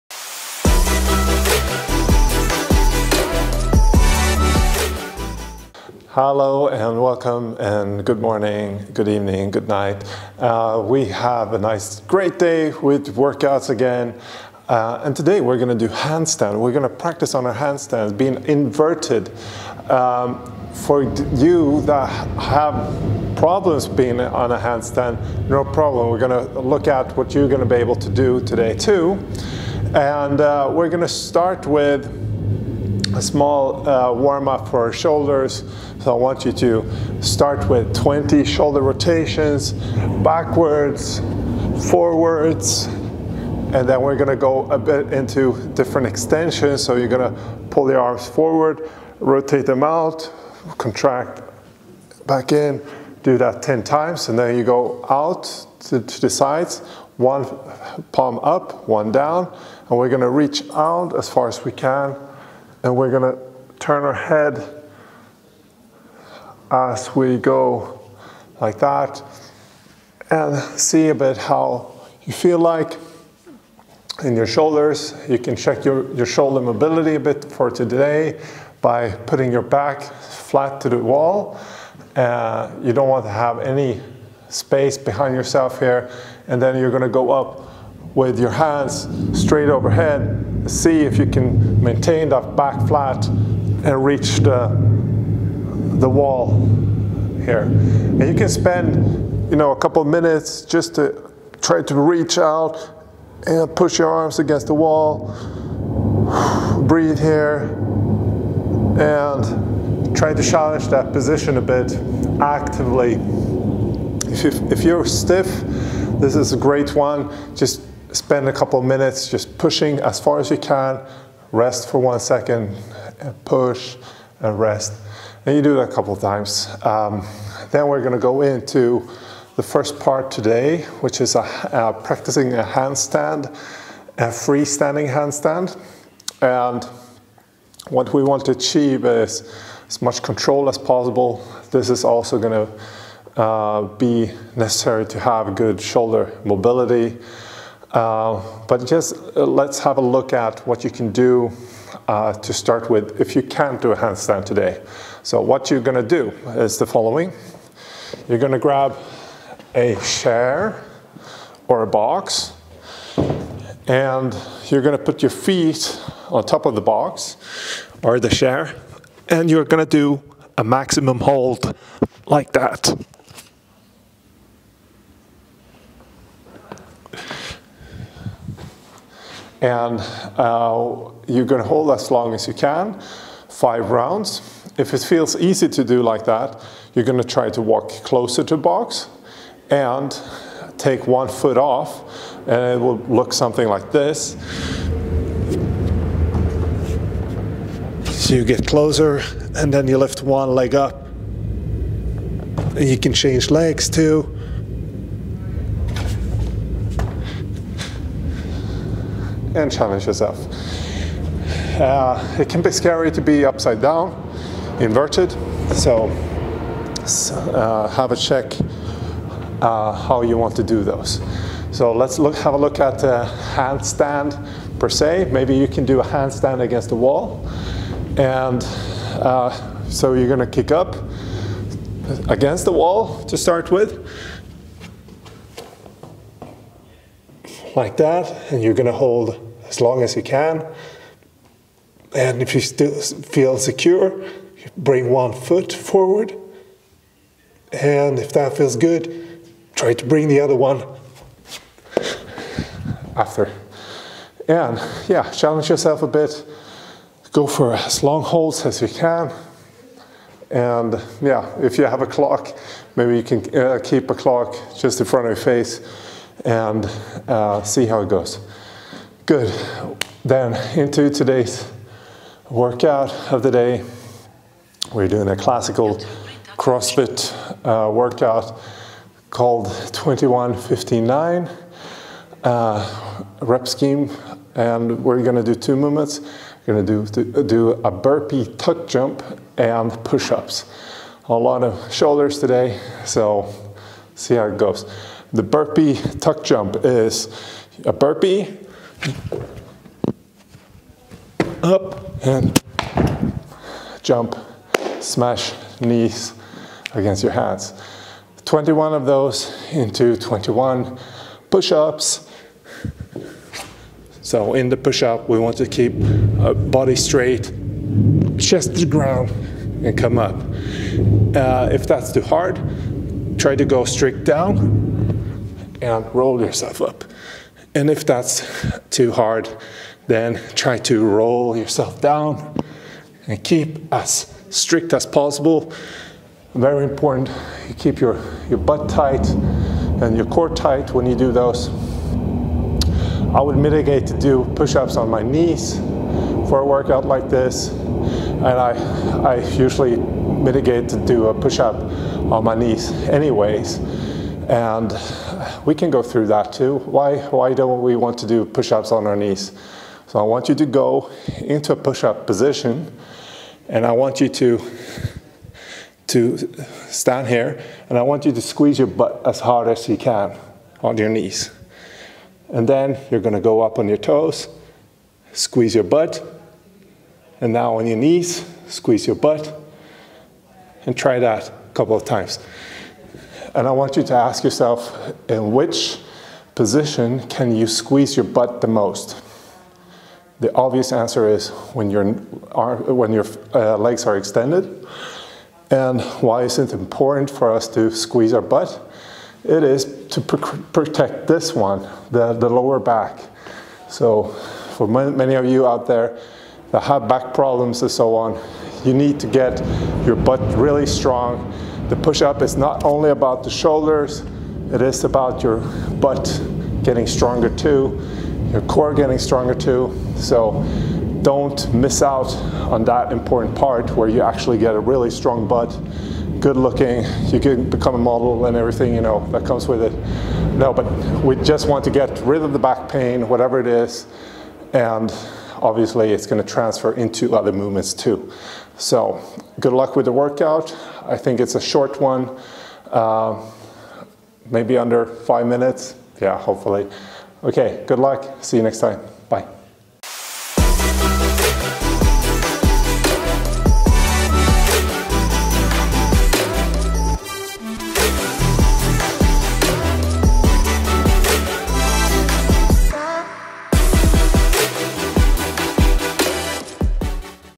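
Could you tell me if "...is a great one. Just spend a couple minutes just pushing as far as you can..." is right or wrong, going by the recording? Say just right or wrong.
right.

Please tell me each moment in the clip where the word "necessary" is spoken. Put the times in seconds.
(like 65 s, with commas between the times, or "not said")
144 s.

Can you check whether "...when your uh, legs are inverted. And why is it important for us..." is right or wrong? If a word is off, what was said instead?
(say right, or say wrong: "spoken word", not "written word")
wrong: "extended", not "inverted".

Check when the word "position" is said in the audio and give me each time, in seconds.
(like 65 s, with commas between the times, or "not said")
111 s, 362 s, 386 s.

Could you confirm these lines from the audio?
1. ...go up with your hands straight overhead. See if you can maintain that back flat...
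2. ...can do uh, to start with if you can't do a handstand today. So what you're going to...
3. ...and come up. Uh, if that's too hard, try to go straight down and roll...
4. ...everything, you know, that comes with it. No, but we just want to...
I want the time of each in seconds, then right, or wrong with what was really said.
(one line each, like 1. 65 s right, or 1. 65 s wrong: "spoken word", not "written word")
1. 87 s right
2. 150 s right
3. 319 s right
4. 428 s right.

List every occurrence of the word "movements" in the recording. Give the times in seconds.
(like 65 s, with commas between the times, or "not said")
285 s, 437 s.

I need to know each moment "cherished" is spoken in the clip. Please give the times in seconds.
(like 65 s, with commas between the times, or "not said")
not said.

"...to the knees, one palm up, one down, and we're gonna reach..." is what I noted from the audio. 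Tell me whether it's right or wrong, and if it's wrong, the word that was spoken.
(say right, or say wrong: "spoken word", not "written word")
wrong: "sides", not "knees".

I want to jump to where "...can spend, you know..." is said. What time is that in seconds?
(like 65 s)
98 s.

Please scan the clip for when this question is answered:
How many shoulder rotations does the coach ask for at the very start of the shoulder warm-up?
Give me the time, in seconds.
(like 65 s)
37 s.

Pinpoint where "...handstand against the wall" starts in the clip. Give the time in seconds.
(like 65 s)
226 s.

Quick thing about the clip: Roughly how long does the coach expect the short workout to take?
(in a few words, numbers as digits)
Under five minutes.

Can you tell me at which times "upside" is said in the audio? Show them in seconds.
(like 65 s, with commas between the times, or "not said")
213 s.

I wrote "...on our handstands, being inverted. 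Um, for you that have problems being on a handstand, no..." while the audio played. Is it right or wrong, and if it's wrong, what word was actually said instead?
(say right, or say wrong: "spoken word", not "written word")
right.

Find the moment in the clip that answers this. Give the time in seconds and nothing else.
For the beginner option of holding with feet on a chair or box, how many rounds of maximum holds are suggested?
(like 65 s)
183 s.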